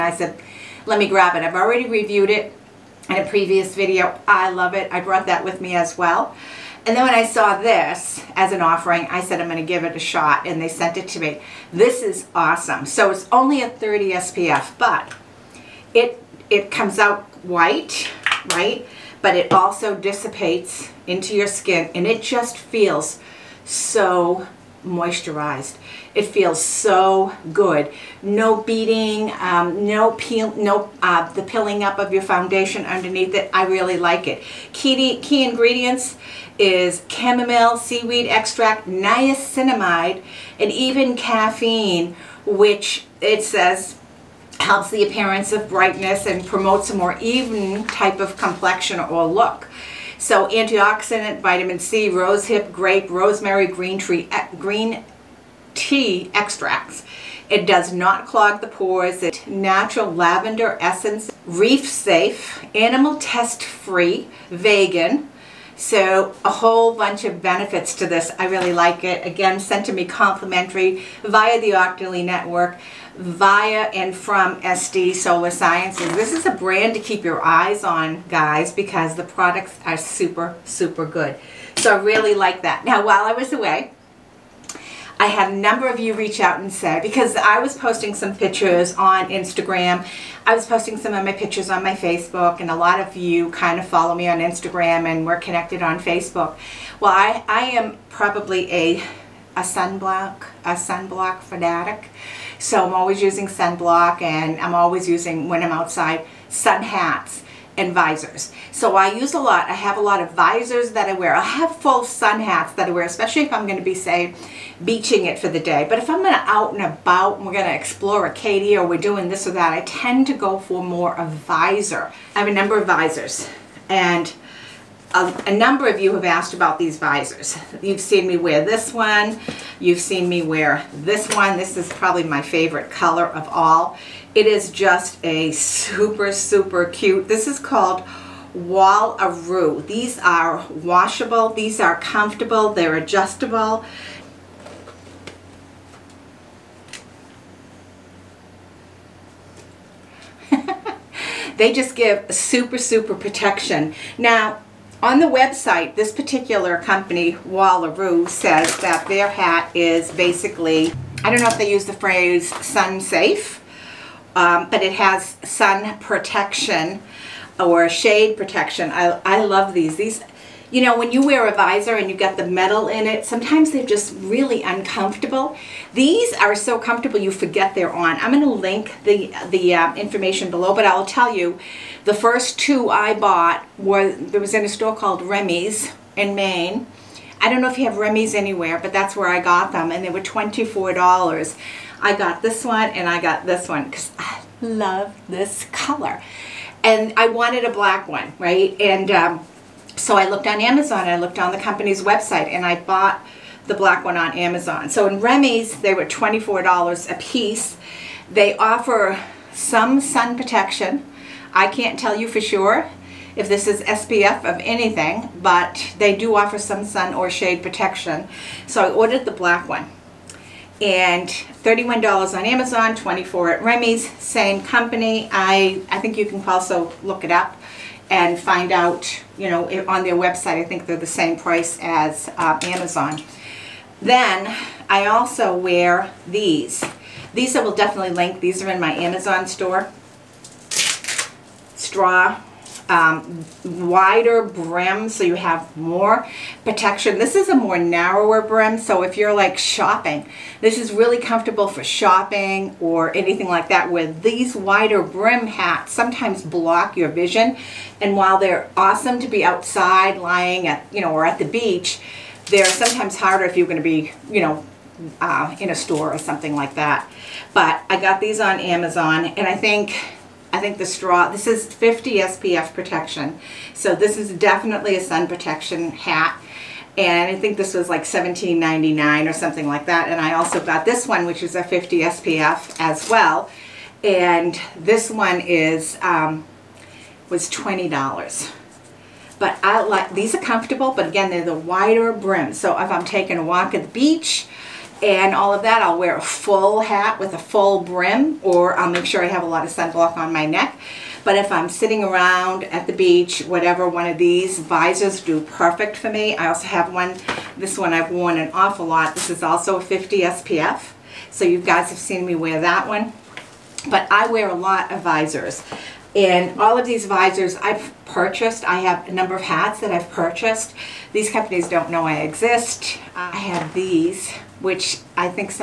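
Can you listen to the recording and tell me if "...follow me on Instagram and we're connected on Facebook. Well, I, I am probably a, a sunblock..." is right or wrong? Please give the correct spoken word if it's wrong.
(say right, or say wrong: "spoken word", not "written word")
right.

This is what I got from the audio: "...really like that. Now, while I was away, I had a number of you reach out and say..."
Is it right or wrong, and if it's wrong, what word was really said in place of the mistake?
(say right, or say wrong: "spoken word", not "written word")
right.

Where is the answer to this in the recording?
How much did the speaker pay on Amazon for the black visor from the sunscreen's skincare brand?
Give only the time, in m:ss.
3:41.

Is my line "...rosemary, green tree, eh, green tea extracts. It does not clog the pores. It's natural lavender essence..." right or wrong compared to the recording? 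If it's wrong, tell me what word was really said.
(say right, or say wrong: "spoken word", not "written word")
right.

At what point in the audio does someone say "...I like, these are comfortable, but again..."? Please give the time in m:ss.
4:49.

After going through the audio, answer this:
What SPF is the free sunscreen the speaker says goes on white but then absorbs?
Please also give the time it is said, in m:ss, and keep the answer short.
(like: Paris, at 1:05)
30, at 0:13.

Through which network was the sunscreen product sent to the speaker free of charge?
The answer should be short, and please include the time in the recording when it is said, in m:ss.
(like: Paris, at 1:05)
Octoly Network, at 1:11.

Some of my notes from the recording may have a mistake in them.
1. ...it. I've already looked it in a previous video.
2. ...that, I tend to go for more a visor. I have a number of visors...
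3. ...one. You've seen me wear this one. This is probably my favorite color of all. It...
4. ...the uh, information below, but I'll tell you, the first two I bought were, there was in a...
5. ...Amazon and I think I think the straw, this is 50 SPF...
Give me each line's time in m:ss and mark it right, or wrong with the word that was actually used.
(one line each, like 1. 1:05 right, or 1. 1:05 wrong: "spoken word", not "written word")
1. 0:01 wrong: "reviewed", not "looked"
2. 1:59 right
3. 2:08 right
4. 2:59 right
5. 4:28 right.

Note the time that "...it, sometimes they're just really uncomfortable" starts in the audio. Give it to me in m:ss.
2:53.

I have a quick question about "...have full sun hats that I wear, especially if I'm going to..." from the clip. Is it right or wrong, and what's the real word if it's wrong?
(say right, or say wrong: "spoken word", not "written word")
right.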